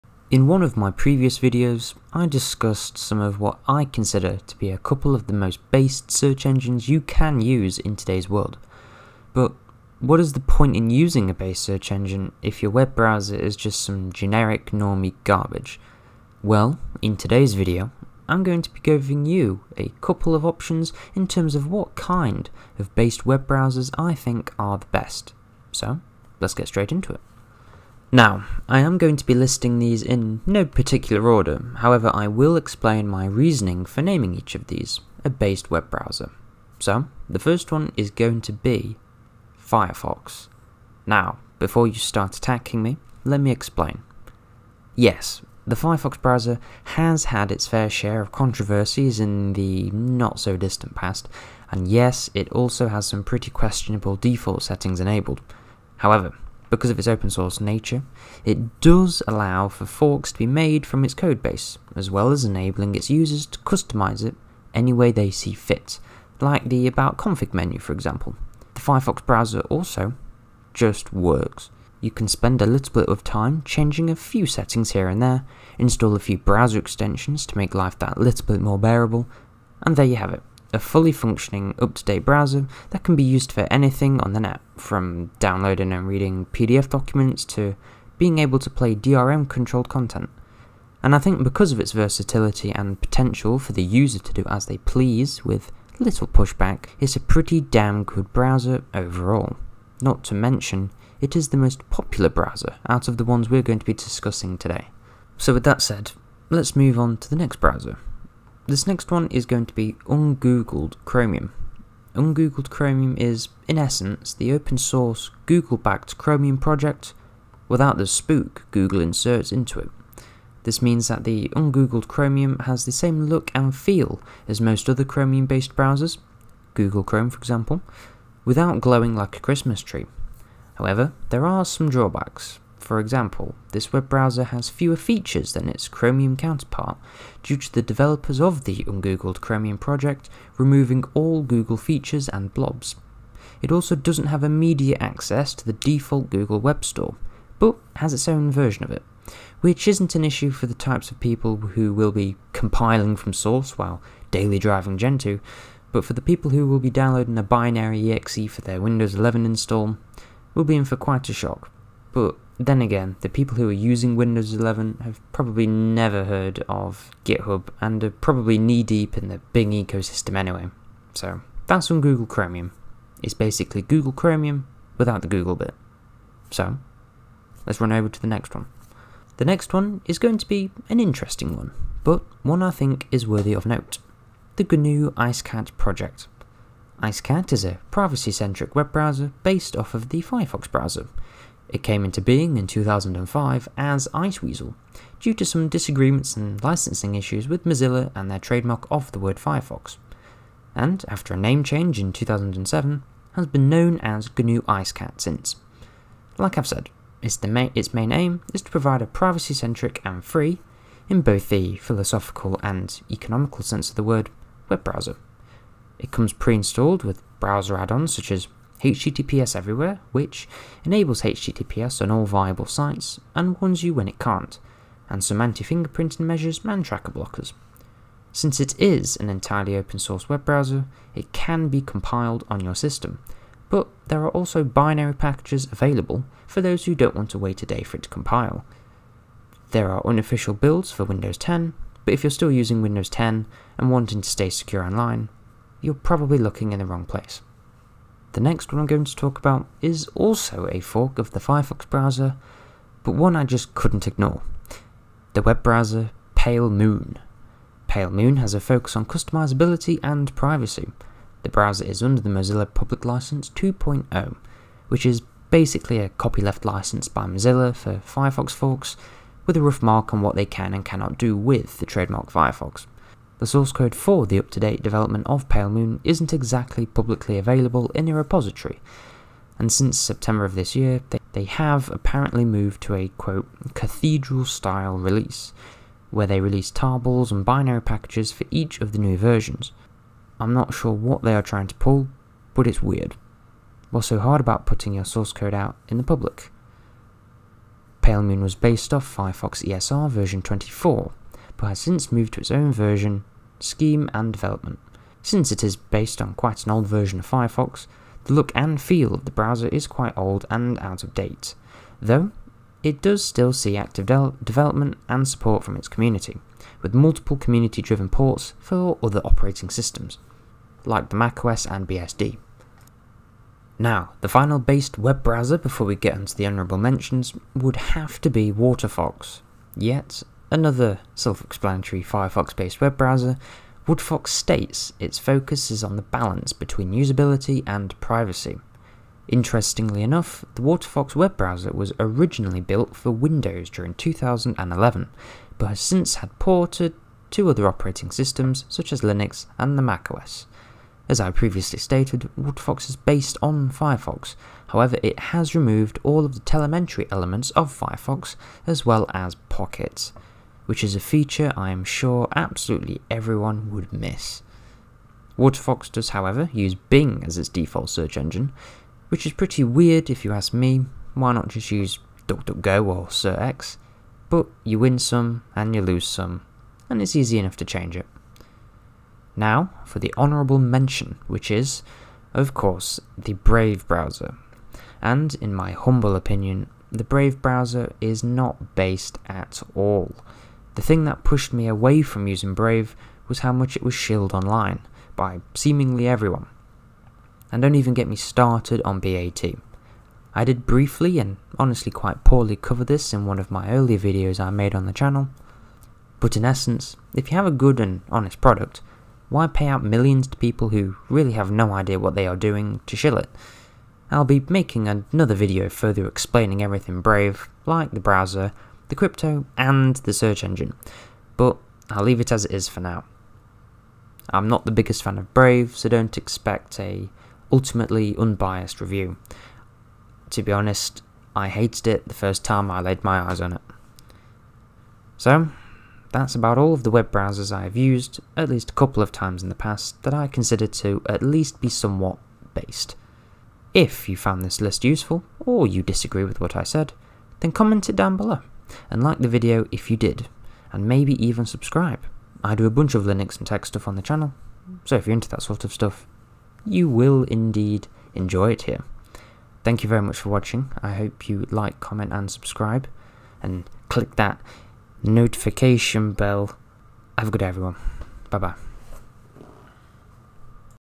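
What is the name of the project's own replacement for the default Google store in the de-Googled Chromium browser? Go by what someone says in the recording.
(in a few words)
Google Web Store.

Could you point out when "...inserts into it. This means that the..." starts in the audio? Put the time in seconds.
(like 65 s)
119 s.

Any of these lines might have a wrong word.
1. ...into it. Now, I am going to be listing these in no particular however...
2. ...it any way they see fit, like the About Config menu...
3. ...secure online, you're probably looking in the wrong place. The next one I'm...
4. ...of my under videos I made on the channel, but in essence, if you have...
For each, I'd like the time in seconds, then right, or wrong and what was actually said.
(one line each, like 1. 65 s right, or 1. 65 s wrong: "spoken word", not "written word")
1. 26 s wrong: "order", not "however"
2. 64 s right
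3. 244 s right
4. 403 s wrong: "earlier", not "under".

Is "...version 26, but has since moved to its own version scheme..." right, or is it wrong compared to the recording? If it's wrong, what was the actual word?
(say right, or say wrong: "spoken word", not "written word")
wrong: "24", not "26".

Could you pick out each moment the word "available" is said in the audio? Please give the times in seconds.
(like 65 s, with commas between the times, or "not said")
235 s, 277 s.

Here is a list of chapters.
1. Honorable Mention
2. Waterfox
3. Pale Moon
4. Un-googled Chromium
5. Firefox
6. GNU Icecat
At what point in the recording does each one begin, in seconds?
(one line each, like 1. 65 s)
1. 380 s
2. 325 s
3. 250 s
4. 110 s
5. 40 s
6. 185 s.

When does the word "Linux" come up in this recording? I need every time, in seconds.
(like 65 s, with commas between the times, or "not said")
349 s, 453 s.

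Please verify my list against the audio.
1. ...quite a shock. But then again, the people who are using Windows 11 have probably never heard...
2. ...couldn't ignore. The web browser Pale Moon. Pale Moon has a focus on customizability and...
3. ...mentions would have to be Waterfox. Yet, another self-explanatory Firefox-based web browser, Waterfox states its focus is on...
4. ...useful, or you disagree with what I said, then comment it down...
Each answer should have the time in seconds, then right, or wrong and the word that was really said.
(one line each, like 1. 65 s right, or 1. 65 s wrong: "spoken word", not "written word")
1. 160 s right
2. 253 s right
3. 326 s right
4. 444 s right.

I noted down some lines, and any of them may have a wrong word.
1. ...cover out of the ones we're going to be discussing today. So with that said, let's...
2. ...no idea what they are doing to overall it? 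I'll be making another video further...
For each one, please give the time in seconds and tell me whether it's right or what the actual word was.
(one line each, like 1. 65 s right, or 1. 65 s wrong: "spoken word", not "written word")
1. 102 s wrong: "browser", not "cover"
2. 411 s wrong: "shill", not "overall".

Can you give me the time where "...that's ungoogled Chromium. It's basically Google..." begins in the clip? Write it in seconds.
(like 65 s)
171 s.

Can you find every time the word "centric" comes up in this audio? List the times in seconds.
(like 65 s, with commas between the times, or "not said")
187 s, 209 s.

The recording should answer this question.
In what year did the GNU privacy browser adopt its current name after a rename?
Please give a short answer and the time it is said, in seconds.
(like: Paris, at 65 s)
2007, at 202 s.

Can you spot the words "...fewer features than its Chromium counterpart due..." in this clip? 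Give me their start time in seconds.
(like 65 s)
134 s.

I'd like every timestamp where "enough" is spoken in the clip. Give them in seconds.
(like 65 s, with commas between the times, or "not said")
340 s, 377 s.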